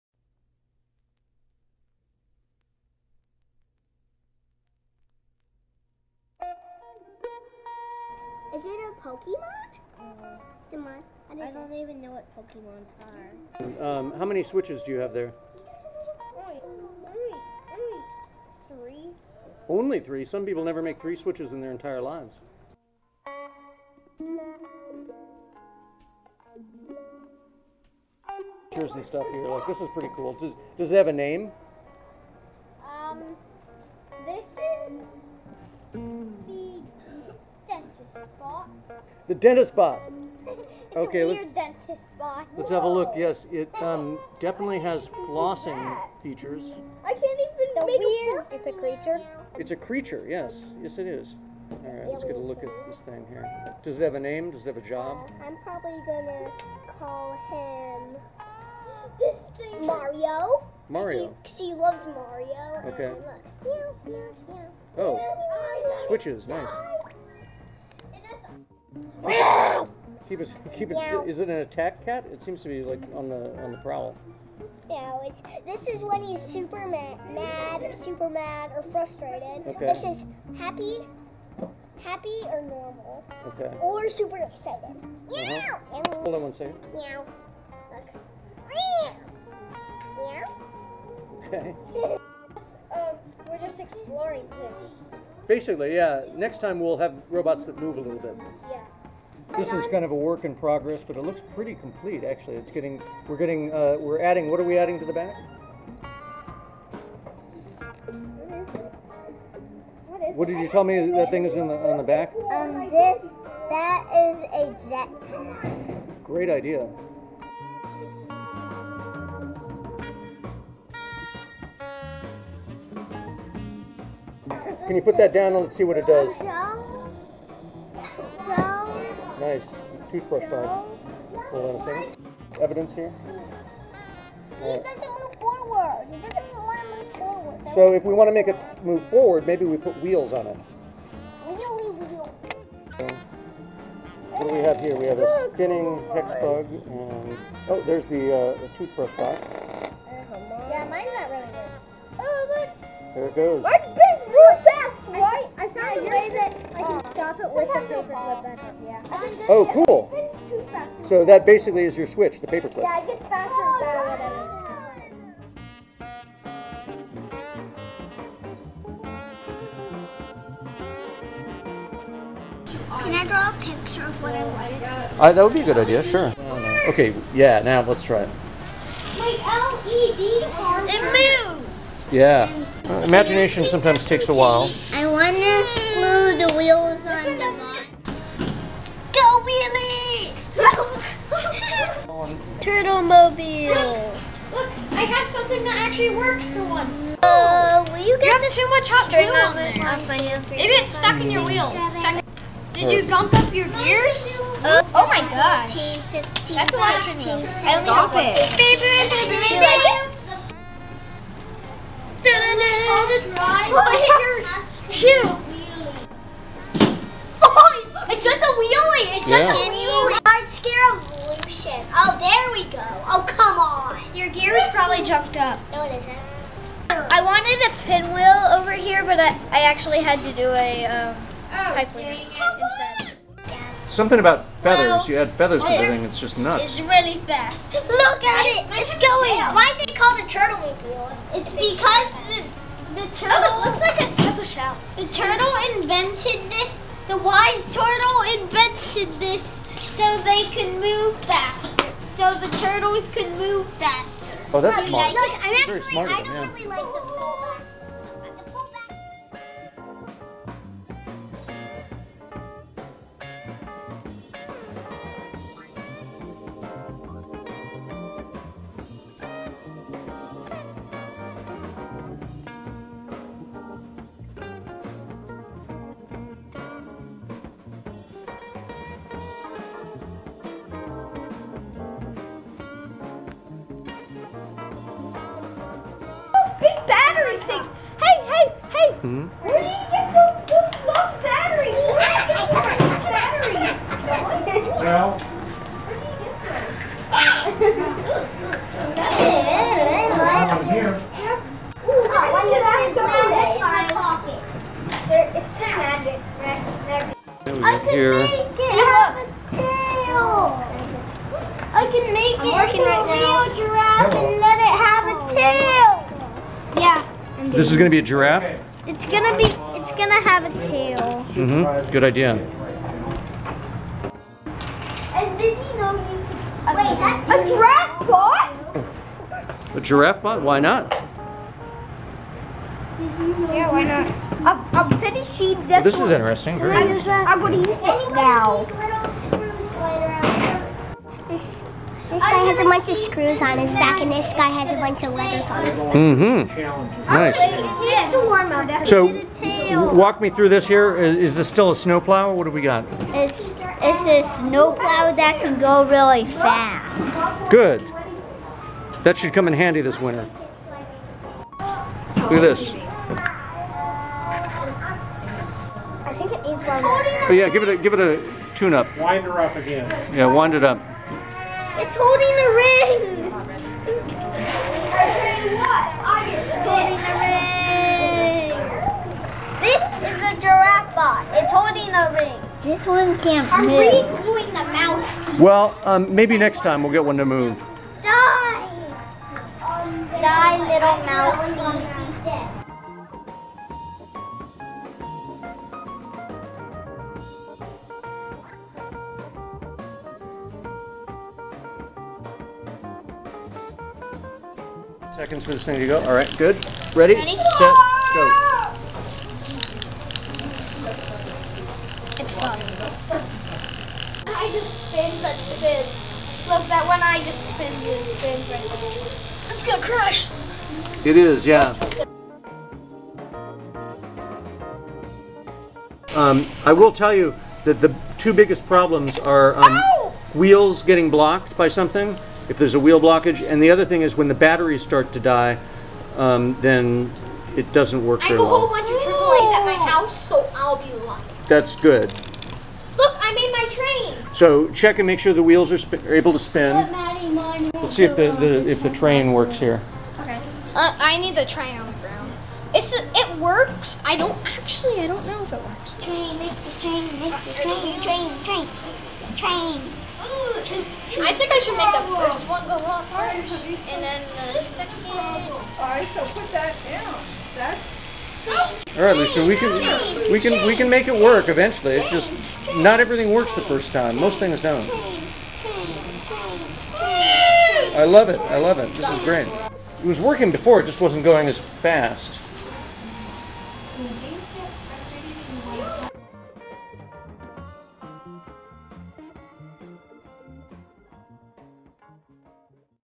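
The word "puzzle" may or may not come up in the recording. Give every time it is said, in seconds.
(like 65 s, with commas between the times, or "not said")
244 s.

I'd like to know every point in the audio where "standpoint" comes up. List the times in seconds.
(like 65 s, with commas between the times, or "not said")
not said.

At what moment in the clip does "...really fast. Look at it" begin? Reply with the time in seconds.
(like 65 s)
236 s.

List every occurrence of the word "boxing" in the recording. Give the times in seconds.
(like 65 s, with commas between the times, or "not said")
not said.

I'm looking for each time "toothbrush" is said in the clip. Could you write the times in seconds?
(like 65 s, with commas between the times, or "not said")
130 s, 148 s.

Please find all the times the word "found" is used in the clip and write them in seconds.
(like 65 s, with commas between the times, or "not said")
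155 s.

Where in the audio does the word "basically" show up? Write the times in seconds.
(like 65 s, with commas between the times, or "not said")
95 s, 161 s.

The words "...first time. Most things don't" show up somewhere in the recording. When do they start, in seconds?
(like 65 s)
473 s.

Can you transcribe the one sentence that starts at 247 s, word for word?
The wise turtle invented this so they can move faster.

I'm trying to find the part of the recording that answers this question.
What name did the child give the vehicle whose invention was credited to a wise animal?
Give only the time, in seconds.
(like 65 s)
192 s.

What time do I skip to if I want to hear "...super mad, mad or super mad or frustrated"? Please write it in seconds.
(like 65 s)
76 s.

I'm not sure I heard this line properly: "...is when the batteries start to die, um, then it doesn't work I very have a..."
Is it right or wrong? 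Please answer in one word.
right.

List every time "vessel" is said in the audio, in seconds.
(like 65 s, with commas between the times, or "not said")
not said.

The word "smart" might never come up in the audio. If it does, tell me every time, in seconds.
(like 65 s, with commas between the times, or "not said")
254 s.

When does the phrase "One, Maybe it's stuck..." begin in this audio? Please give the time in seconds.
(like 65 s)
199 s.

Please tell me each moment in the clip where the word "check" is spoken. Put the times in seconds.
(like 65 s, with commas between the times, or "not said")
202 s, 444 s.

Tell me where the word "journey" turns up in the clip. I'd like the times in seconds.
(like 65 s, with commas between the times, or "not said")
not said.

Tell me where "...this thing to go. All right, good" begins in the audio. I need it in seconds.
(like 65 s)
405 s.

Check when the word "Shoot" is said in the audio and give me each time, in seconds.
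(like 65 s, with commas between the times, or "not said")
214 s.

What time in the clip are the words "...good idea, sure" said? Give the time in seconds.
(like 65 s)
175 s.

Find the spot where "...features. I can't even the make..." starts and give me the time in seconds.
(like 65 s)
46 s.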